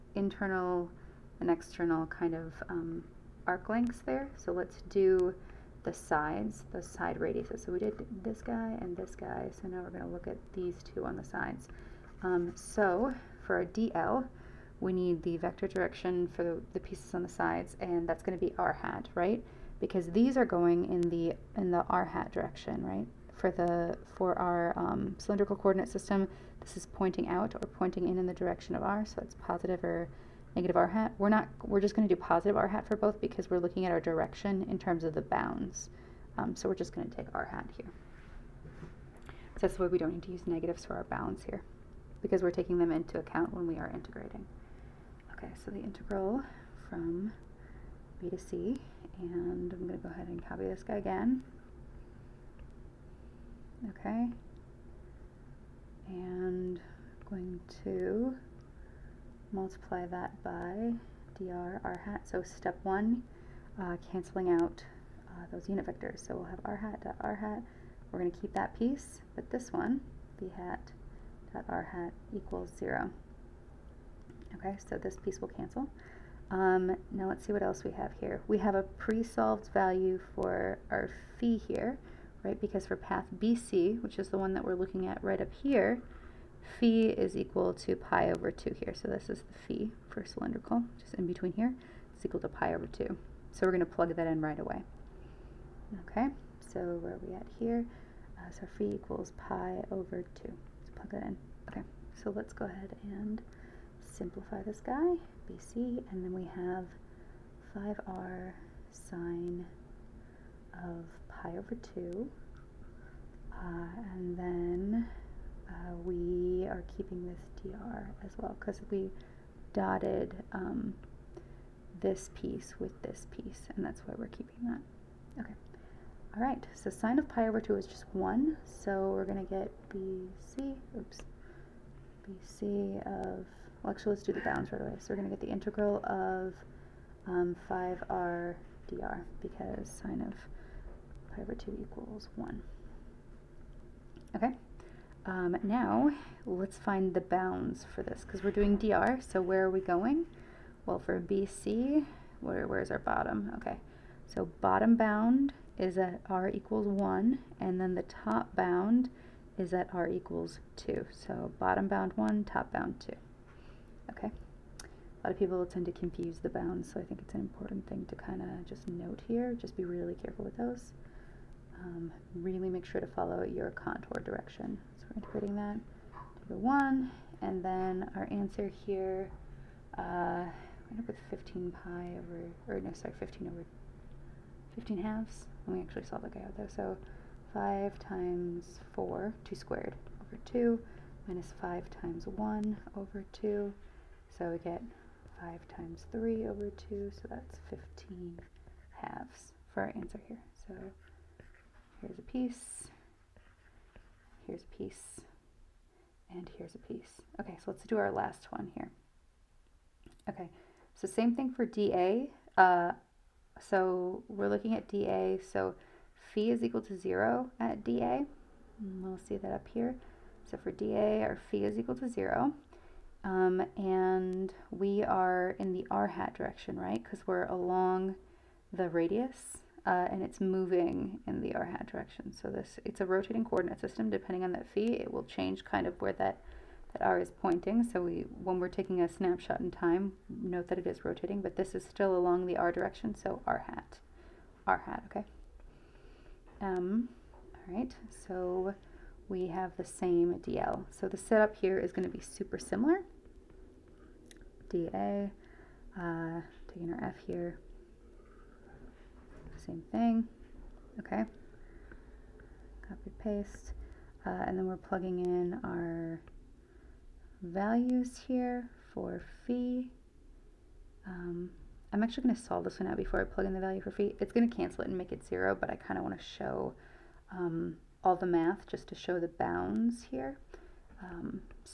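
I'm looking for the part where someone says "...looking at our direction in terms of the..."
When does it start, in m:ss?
0:33.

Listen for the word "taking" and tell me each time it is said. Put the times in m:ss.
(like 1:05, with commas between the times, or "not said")
0:42, 3:58, 4:16.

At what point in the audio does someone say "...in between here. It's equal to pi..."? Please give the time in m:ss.
1:31.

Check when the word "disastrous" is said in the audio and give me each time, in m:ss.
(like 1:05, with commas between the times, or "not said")
not said.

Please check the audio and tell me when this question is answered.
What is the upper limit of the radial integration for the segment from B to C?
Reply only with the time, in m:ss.
2:38.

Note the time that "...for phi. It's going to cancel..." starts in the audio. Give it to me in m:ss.
4:33.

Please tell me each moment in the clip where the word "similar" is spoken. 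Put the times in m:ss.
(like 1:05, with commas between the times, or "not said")
4:12.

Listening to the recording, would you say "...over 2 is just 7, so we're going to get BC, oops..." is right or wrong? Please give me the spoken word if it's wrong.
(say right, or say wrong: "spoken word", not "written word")
wrong: "1", not "7".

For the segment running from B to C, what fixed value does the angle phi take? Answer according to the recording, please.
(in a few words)
pi/2.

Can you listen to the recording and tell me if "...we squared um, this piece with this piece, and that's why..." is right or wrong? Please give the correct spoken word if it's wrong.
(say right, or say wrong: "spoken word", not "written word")
wrong: "dotted", not "squared".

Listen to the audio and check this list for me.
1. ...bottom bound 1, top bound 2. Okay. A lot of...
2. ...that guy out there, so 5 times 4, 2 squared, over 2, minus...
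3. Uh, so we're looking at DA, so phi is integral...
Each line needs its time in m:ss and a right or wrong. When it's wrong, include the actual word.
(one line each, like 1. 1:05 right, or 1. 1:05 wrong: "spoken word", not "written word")
1. 2:41 right
2. 3:06 right
3. 3:32 wrong: "equal", not "integral".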